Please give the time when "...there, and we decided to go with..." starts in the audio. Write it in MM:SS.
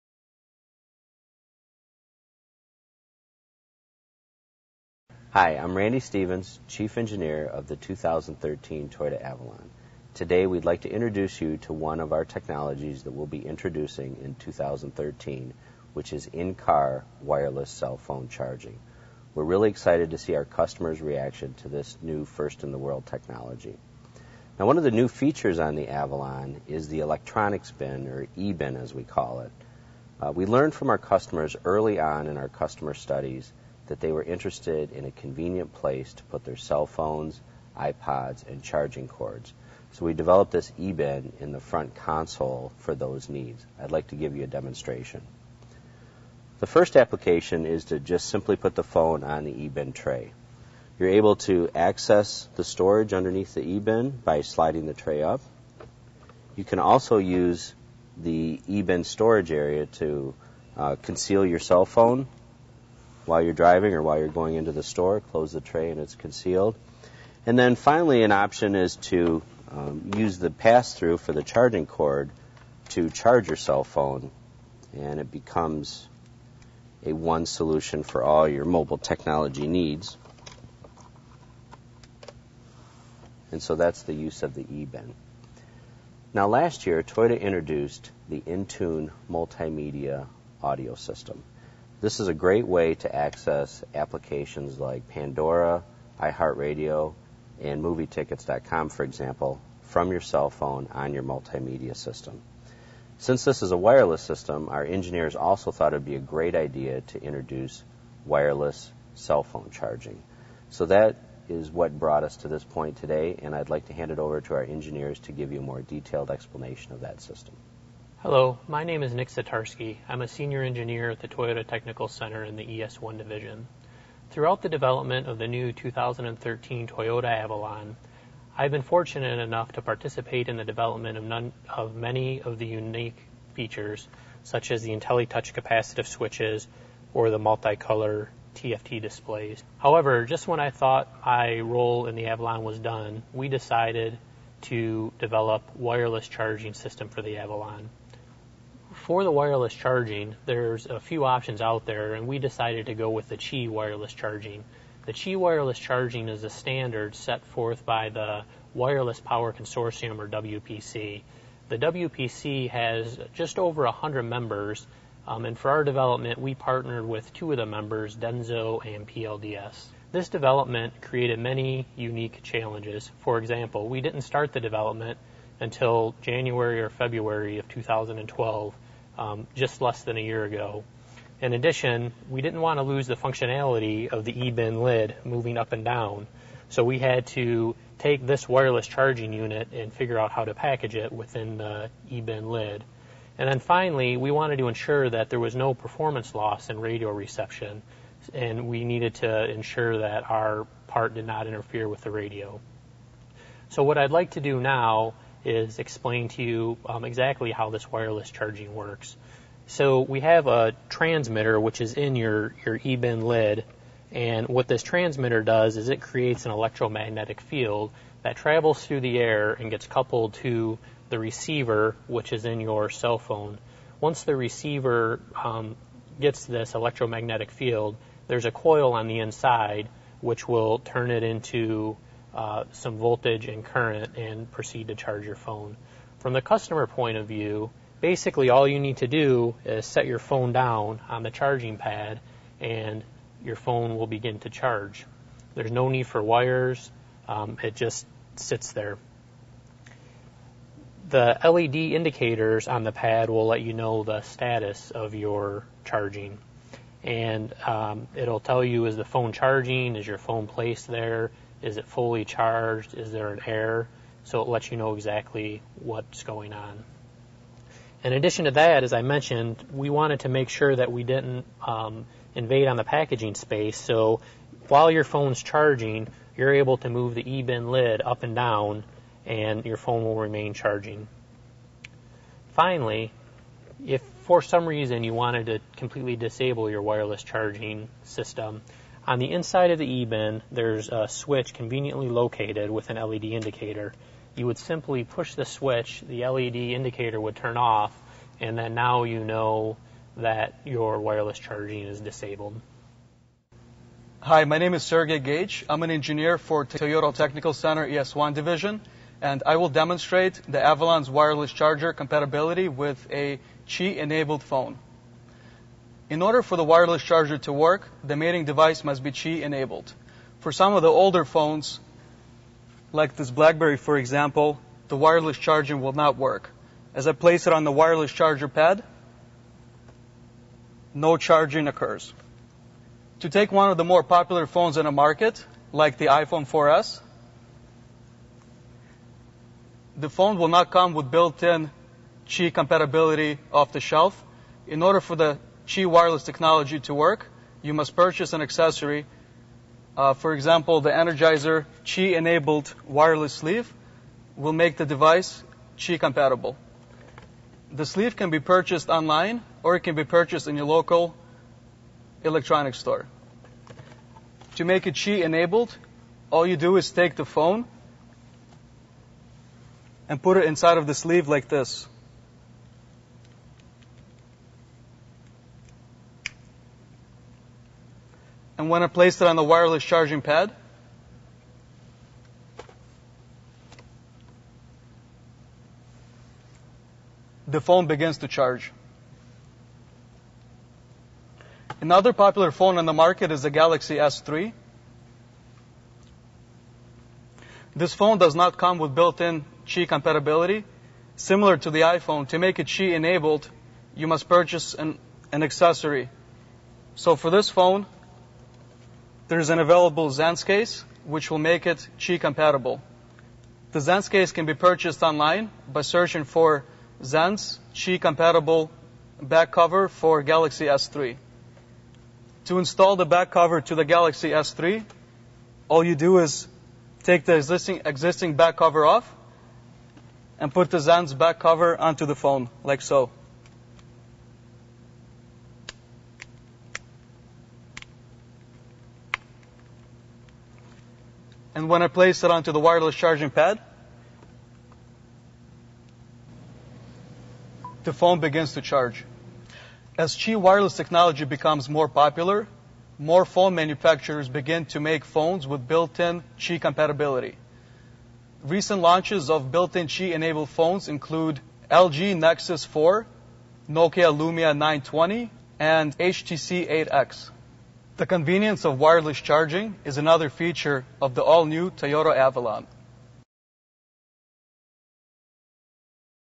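02:31.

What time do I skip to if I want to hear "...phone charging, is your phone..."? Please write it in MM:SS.
04:19.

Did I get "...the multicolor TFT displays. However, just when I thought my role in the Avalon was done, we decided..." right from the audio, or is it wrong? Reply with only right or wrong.
right.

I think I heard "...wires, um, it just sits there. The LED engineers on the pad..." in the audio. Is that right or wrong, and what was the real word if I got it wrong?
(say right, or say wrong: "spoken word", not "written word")
wrong: "indicators", not "engineers".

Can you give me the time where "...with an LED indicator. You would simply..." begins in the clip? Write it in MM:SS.
04:52.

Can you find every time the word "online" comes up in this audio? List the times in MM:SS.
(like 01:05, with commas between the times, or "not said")
05:58, 06:55.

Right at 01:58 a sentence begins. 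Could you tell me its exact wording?
Hello, my name is Nick Satarski.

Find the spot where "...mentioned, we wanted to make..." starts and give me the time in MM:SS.
04:29.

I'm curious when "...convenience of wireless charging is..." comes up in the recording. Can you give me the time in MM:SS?
07:48.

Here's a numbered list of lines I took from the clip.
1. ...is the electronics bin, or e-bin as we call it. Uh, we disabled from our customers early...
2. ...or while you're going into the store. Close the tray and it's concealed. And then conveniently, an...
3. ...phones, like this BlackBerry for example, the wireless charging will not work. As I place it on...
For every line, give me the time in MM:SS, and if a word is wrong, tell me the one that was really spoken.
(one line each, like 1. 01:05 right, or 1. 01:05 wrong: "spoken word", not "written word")
1. 00:26 wrong: "learned", not "disabled"
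2. 01:03 wrong: "finally", not "conveniently"
3. 05:21 right.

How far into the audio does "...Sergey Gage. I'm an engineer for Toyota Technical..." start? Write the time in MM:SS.
05:04.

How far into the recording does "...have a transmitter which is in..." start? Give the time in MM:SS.
03:30.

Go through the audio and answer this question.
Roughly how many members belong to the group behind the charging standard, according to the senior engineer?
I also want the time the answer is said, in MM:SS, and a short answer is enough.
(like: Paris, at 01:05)
just over 100, at 02:43.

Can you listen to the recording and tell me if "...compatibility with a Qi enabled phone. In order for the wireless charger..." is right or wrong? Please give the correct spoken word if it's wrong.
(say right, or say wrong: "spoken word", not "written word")
right.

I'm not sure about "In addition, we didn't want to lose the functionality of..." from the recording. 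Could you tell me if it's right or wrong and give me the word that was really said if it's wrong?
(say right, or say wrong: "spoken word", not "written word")
right.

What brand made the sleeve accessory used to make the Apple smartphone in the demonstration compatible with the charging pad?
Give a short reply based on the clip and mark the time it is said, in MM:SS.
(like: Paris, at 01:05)
Energizer, at 05:50.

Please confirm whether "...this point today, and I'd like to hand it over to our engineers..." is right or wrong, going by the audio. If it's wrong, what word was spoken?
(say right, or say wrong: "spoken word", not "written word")
right.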